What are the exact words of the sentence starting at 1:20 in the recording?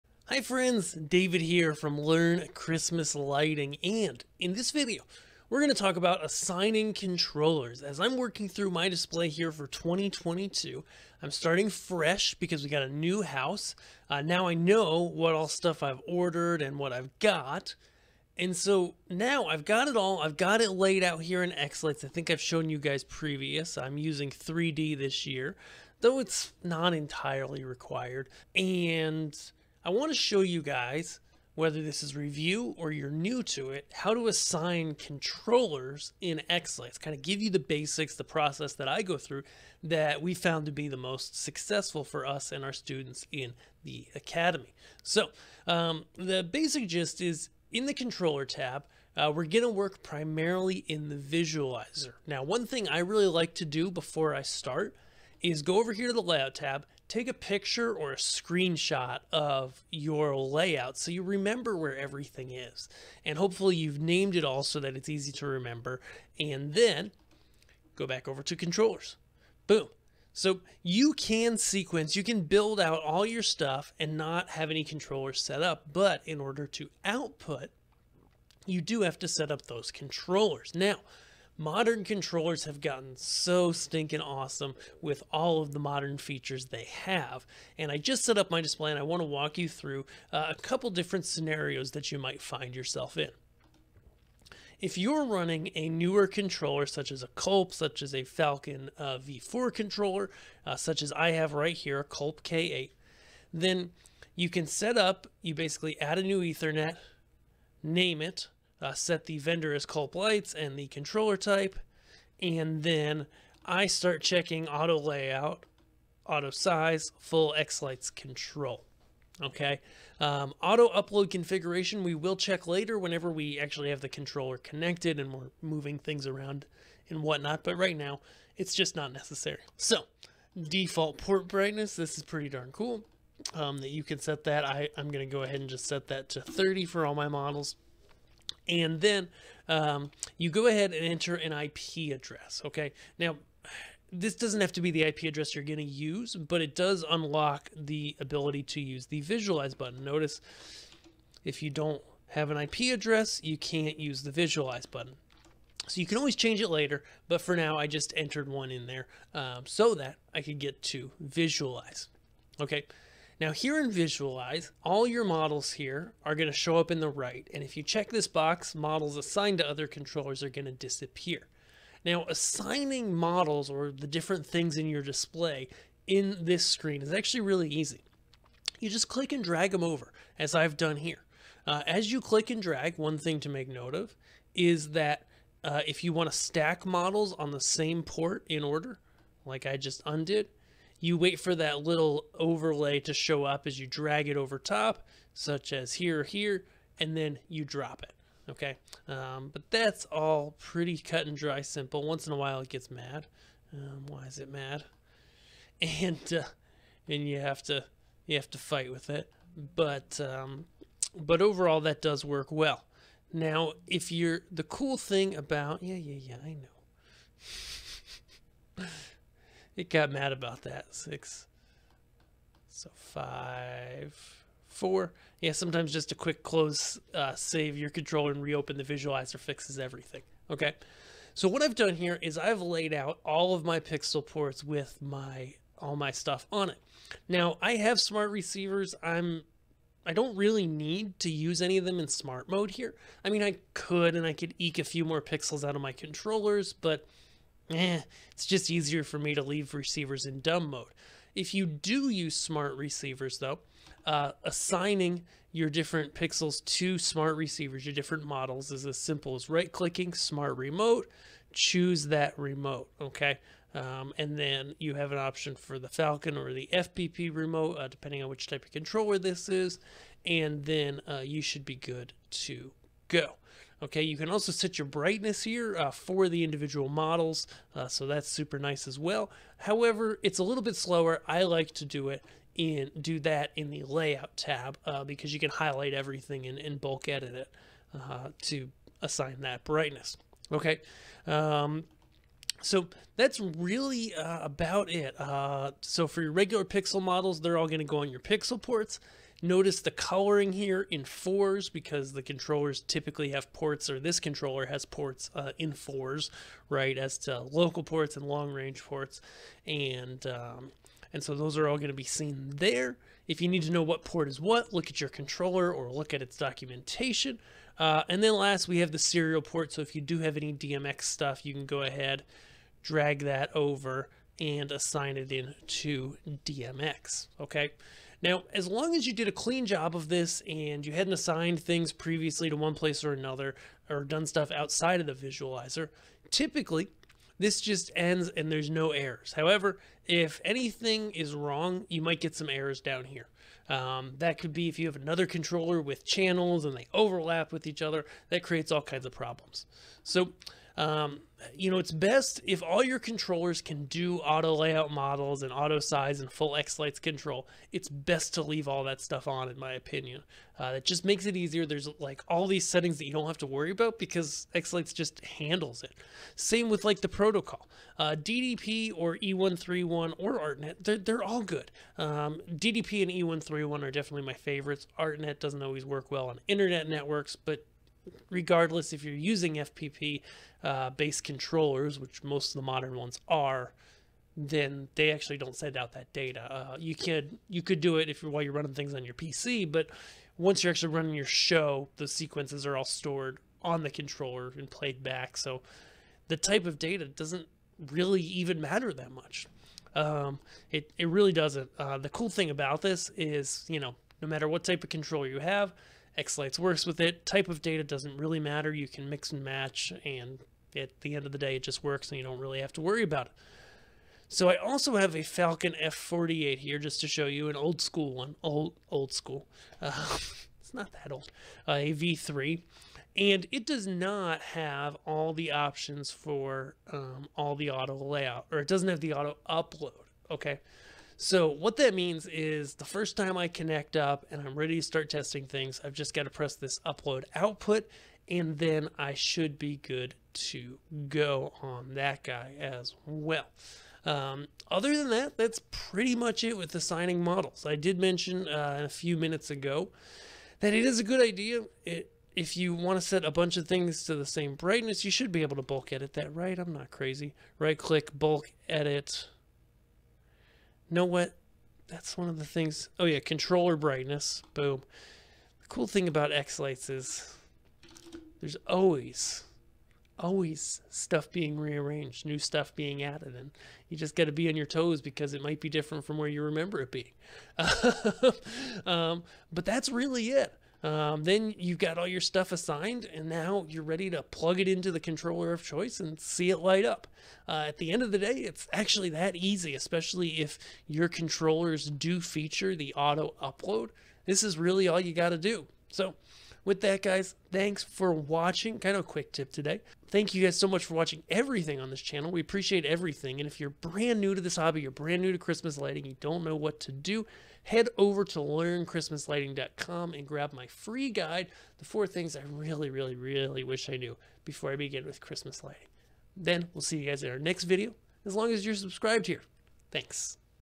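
Now, Modern controllers have gotten so stinking awesome with all of the modern features they have.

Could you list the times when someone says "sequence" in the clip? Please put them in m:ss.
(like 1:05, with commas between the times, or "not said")
1:11, 6:32.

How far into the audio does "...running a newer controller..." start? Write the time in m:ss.
1:35.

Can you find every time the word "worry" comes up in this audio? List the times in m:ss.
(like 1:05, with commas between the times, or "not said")
6:03, 6:52.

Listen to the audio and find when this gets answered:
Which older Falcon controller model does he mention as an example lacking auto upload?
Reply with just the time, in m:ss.
6:55.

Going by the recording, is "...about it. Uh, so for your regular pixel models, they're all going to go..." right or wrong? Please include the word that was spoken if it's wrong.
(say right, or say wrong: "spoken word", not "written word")
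right.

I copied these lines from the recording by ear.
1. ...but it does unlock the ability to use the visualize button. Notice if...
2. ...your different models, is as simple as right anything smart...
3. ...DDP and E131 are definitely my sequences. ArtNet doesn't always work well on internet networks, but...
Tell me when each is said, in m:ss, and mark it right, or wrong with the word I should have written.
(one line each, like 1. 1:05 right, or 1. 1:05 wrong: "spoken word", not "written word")
1. 2:26 right
2. 4:17 wrong: "clicking", not "anything"
3. 6:12 wrong: "favorites", not "sequences".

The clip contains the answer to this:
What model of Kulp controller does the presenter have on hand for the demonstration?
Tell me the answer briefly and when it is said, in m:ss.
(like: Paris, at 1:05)
Kulp K8, at 1:42.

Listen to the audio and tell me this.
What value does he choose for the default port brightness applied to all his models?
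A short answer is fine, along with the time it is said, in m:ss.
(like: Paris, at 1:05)
30, at 2:16.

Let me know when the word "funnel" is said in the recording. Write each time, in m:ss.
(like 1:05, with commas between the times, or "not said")
not said.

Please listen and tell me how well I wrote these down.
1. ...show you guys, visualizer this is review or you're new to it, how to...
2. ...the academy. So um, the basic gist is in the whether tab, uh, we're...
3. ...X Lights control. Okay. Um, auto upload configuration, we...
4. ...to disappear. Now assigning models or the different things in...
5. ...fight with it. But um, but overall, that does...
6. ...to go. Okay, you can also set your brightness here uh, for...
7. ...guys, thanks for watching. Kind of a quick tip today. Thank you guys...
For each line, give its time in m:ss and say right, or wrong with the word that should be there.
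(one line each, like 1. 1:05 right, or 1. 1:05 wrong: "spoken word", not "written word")
1. 0:30 wrong: "whether", not "visualizer"
2. 0:43 wrong: "controller", not "whether"
3. 1:57 right
4. 2:50 right
5. 3:28 right
6. 4:32 right
7. 8:17 right.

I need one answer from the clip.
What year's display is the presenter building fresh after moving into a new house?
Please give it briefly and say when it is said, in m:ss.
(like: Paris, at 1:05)
2022, at 0:09.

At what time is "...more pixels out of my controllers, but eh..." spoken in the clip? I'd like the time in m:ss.
4:05.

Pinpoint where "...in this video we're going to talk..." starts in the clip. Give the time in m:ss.
0:04.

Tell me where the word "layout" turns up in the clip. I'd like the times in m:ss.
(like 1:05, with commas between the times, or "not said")
0:56, 1:00, 1:54, 4:43, 5:54, 7:07.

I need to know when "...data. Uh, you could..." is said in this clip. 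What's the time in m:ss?
6:26.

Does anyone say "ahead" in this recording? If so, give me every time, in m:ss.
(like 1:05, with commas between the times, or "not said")
2:15, 2:20, 5:21.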